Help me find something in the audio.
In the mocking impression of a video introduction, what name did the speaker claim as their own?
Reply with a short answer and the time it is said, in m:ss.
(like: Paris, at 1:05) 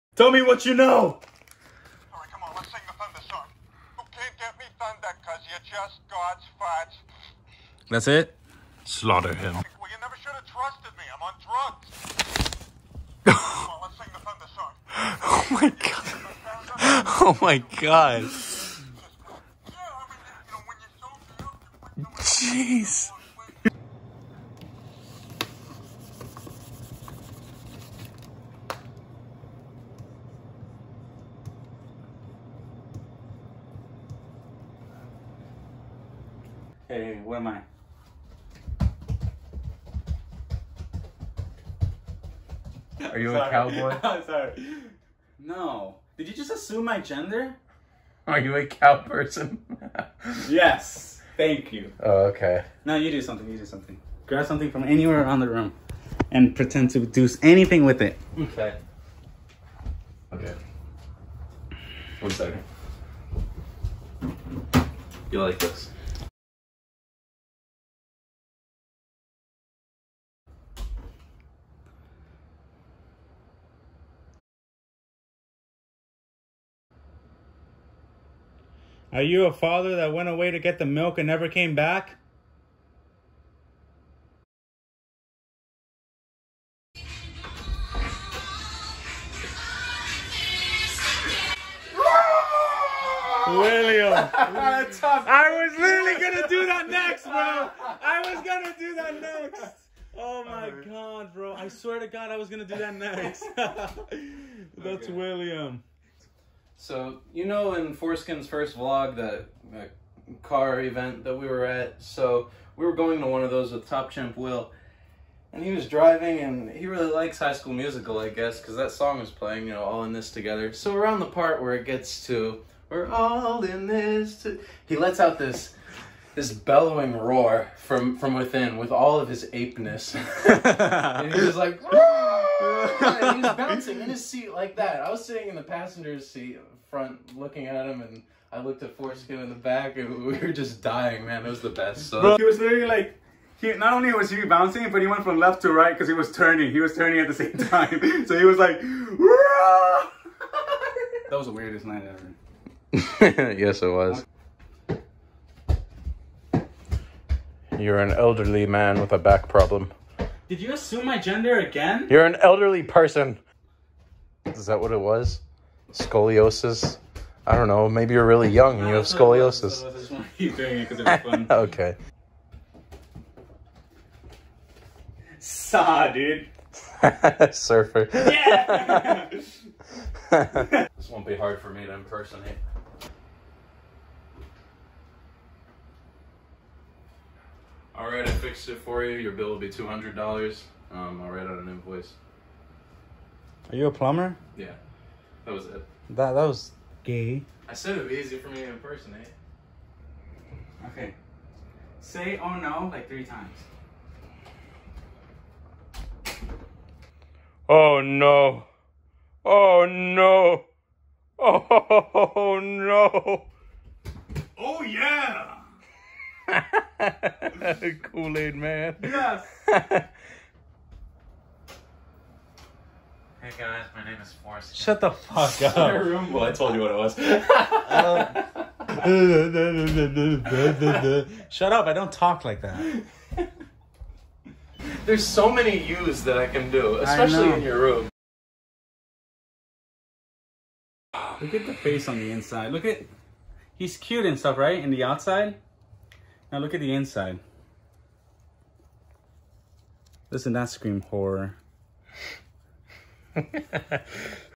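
Forrest, at 3:44.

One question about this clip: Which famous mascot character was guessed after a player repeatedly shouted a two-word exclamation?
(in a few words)
Kool Aid Man.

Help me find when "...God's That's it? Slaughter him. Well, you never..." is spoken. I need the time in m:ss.
0:06.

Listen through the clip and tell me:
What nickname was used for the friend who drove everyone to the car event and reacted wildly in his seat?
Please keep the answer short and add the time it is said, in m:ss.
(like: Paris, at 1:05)
Top Chimp Will, at 1:53.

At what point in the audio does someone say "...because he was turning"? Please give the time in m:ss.
2:25.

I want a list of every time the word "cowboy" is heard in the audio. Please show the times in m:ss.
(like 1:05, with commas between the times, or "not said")
0:43.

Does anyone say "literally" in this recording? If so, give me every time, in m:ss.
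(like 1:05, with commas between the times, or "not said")
1:35, 2:22.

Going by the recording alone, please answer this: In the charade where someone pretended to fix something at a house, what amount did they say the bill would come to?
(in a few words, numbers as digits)
$200.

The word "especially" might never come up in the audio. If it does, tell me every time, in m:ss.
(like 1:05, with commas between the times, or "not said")
3:56.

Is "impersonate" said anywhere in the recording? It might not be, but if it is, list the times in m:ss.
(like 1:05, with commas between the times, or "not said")
3:01, 3:18.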